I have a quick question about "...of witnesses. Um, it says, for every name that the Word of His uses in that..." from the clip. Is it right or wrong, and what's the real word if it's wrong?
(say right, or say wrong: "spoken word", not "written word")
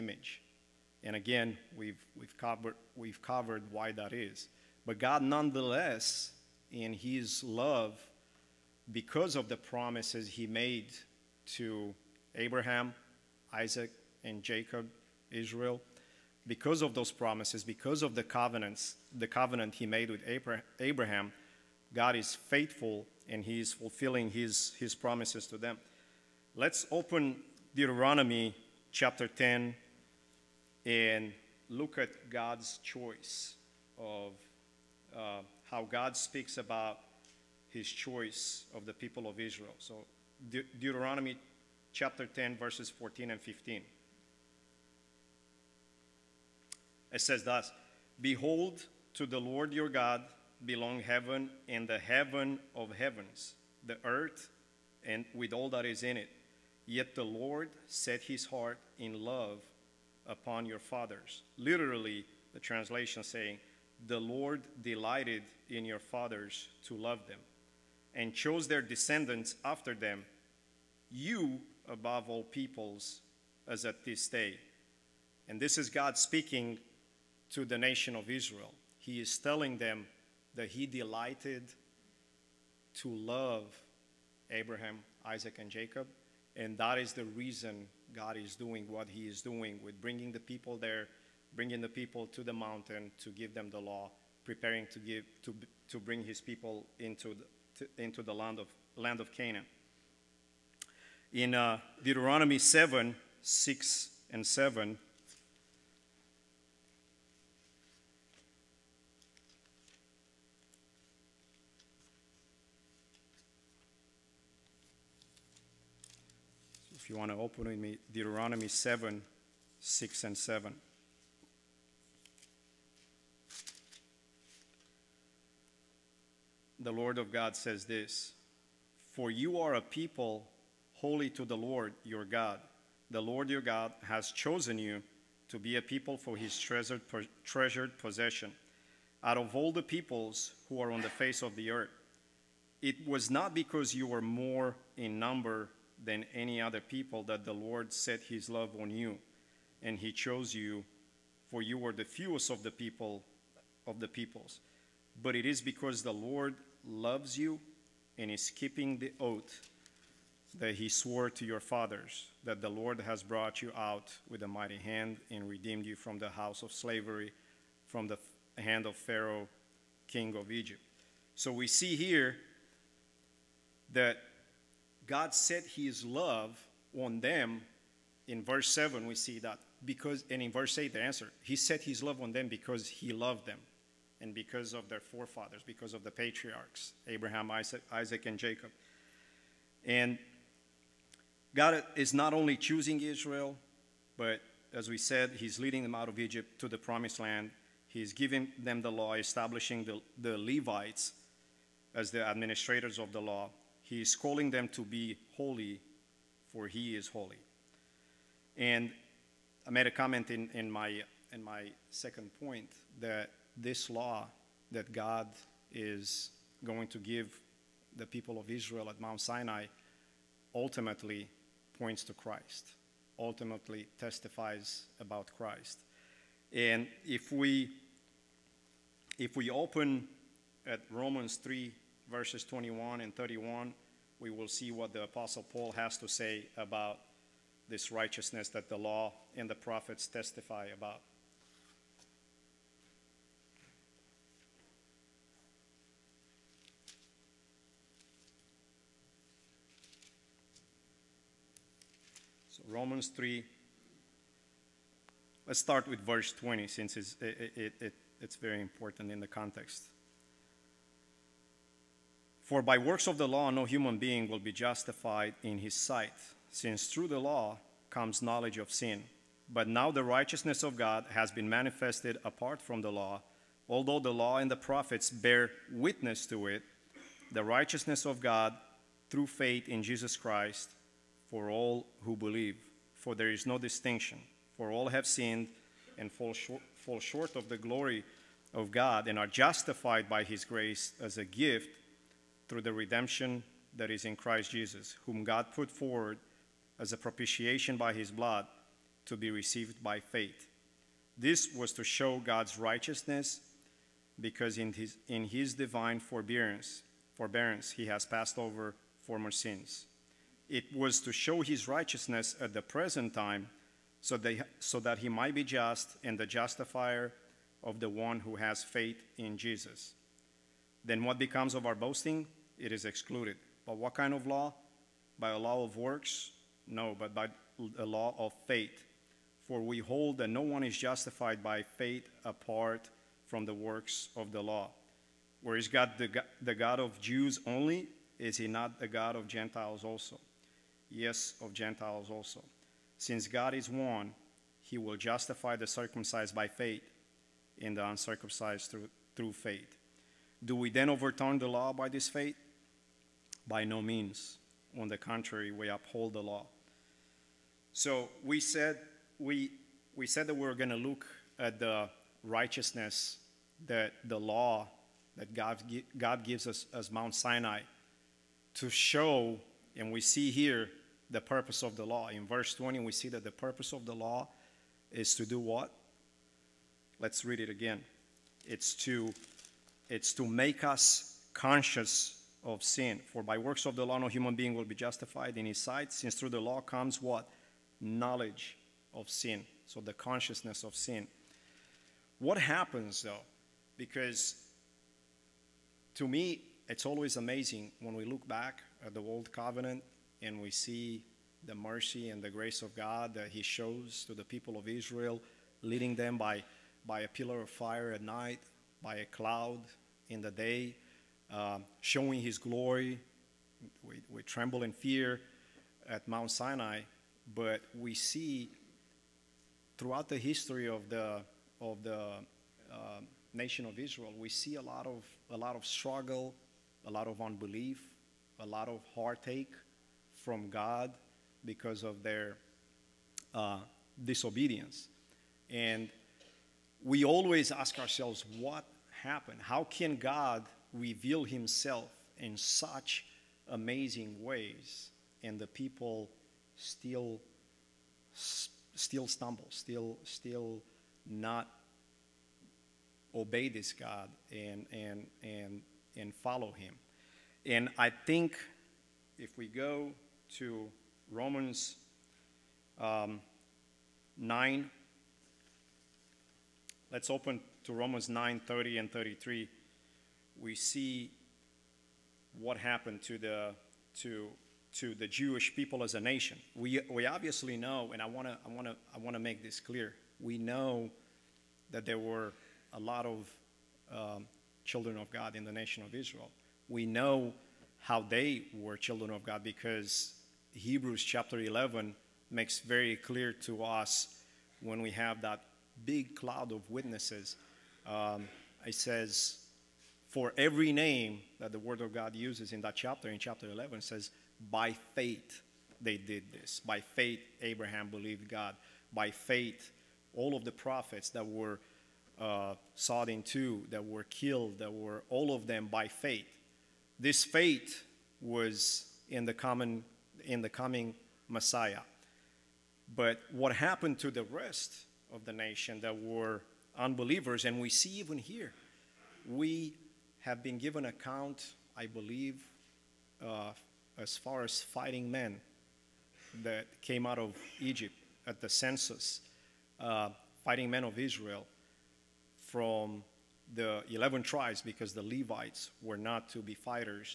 wrong: "God", not "His".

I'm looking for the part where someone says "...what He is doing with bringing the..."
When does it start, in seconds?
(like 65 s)
88 s.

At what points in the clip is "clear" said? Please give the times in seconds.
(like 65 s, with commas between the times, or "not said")
479 s, 492 s.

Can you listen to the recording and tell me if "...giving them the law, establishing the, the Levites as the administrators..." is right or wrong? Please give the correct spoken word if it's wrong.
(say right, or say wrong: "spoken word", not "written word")
right.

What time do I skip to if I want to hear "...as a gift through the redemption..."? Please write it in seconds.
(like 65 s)
291 s.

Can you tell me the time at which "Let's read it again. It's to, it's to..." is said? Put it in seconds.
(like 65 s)
376 s.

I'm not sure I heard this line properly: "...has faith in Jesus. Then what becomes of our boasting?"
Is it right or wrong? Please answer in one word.
right.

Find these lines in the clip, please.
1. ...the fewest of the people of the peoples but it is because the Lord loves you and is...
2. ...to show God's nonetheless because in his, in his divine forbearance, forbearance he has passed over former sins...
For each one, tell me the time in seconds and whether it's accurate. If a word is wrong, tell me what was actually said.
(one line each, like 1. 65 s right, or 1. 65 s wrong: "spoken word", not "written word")
1. 151 s right
2. 301 s wrong: "righteousness", not "nonetheless".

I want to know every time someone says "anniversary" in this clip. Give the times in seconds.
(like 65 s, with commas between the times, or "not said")
not said.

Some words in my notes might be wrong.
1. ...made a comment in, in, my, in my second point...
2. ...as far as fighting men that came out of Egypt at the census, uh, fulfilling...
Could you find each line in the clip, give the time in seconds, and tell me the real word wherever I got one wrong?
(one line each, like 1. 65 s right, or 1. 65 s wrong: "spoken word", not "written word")
1. 209 s right
2. 533 s wrong: "fighting", not "fulfilling".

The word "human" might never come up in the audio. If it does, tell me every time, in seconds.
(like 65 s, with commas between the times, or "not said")
263 s, 384 s.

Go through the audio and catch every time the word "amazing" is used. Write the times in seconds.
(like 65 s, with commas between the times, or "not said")
397 s, 443 s.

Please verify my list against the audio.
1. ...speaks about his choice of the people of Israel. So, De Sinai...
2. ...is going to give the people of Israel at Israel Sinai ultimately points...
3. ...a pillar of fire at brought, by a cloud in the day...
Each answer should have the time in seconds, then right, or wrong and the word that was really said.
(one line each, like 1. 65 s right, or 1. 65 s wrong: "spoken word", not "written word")
1. 36 s wrong: "Deuteronomy", not "Sinai"
2. 215 s wrong: "Mount", not "Israel"
3. 407 s wrong: "night", not "brought".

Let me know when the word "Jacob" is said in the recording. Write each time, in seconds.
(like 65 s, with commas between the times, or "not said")
14 s, 85 s, 188 s.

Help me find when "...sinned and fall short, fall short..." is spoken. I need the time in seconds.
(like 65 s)
285 s.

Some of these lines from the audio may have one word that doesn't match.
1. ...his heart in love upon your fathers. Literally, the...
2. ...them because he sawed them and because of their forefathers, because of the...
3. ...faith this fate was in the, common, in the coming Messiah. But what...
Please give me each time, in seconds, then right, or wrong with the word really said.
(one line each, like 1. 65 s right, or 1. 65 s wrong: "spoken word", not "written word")
1. 58 s right
2. 182 s wrong: "loved", not "sawed"
3. 515 s right.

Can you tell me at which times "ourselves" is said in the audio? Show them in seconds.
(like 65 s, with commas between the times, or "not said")
437 s.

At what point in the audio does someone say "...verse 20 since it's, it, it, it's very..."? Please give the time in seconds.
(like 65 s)
255 s.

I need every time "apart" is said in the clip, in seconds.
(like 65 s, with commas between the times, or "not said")
272 s, 332 s.